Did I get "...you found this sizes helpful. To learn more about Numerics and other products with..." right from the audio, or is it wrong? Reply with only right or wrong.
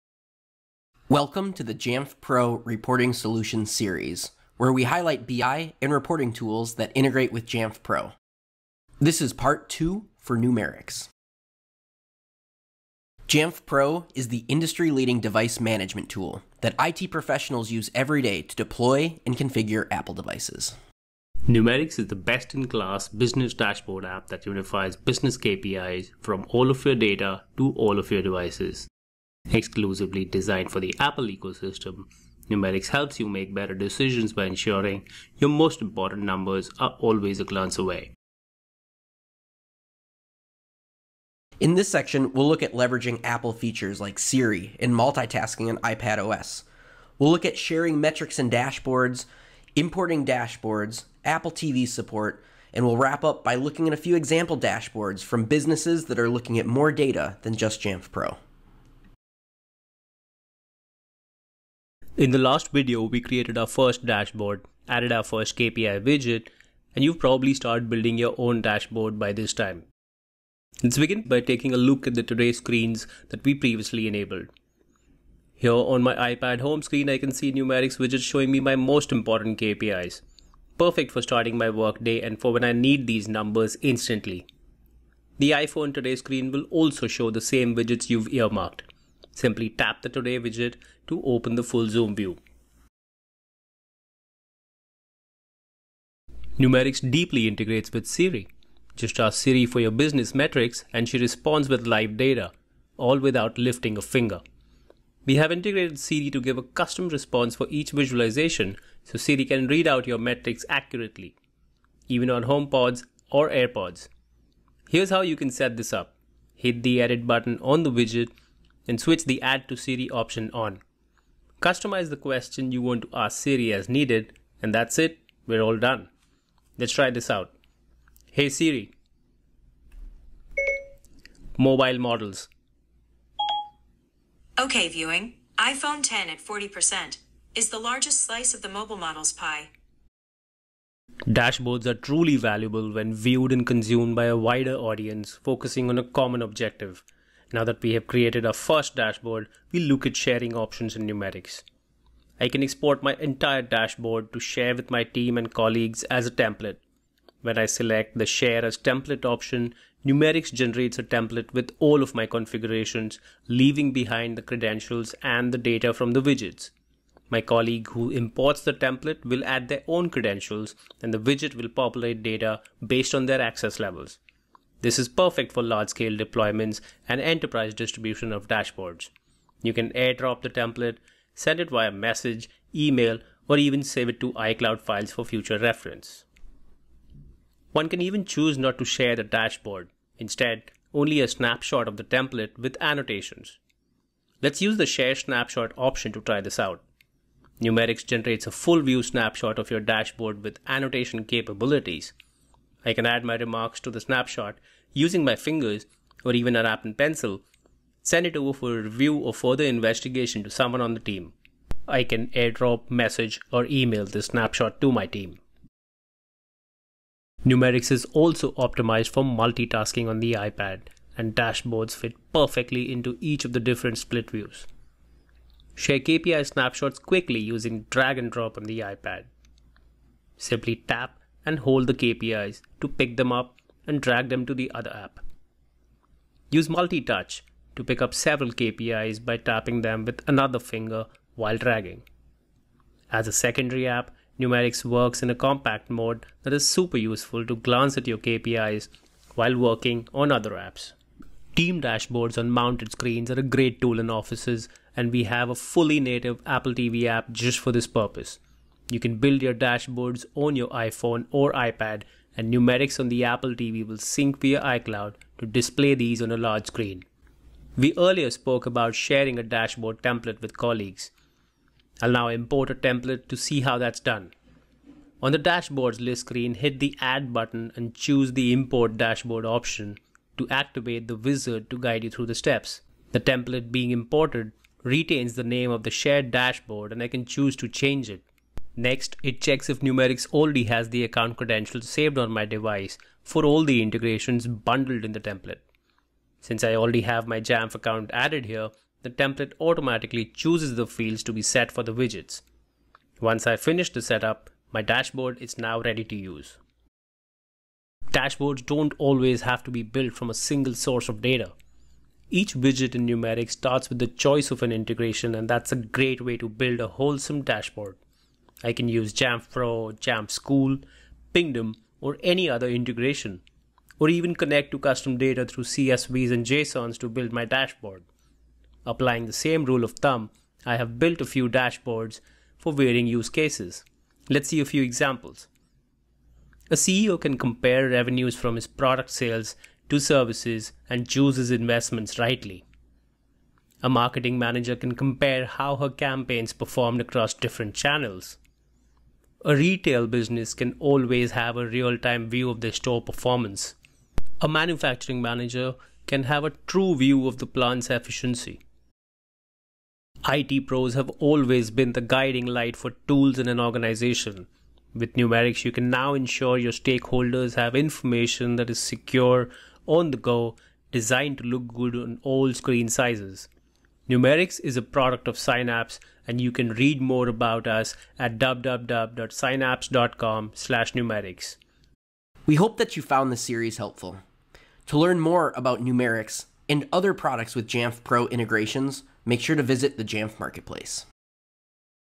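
wrong.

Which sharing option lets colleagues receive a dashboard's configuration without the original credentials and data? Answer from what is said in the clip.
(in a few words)
Share as template.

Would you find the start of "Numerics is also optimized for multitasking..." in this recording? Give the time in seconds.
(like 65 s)
217 s.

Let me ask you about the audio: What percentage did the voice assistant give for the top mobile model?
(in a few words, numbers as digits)
40%.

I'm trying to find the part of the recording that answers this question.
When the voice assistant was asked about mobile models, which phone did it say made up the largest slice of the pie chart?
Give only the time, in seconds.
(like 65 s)
135 s.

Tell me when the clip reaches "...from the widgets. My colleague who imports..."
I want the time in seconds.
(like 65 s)
165 s.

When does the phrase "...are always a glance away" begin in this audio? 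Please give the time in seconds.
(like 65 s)
36 s.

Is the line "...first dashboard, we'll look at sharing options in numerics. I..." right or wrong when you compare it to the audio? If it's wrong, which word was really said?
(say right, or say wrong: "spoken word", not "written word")
right.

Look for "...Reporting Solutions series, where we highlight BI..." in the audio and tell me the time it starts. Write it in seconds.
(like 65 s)
2 s.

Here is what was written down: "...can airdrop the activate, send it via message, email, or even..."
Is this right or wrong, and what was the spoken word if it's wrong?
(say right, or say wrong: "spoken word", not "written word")
wrong: "template", not "activate".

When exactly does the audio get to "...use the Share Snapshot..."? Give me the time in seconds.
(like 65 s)
194 s.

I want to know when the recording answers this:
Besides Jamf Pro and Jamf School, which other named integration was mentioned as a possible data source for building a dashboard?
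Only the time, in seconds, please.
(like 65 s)
321 s.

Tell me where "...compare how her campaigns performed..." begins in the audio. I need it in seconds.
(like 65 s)
344 s.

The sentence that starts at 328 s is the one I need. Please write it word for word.
Applying the same rule of thumb, I have built a few dashboards for varying use cases.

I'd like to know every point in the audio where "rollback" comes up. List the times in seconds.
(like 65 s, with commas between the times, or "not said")
not said.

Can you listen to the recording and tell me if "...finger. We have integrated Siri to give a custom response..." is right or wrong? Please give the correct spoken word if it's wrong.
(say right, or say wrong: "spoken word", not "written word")
right.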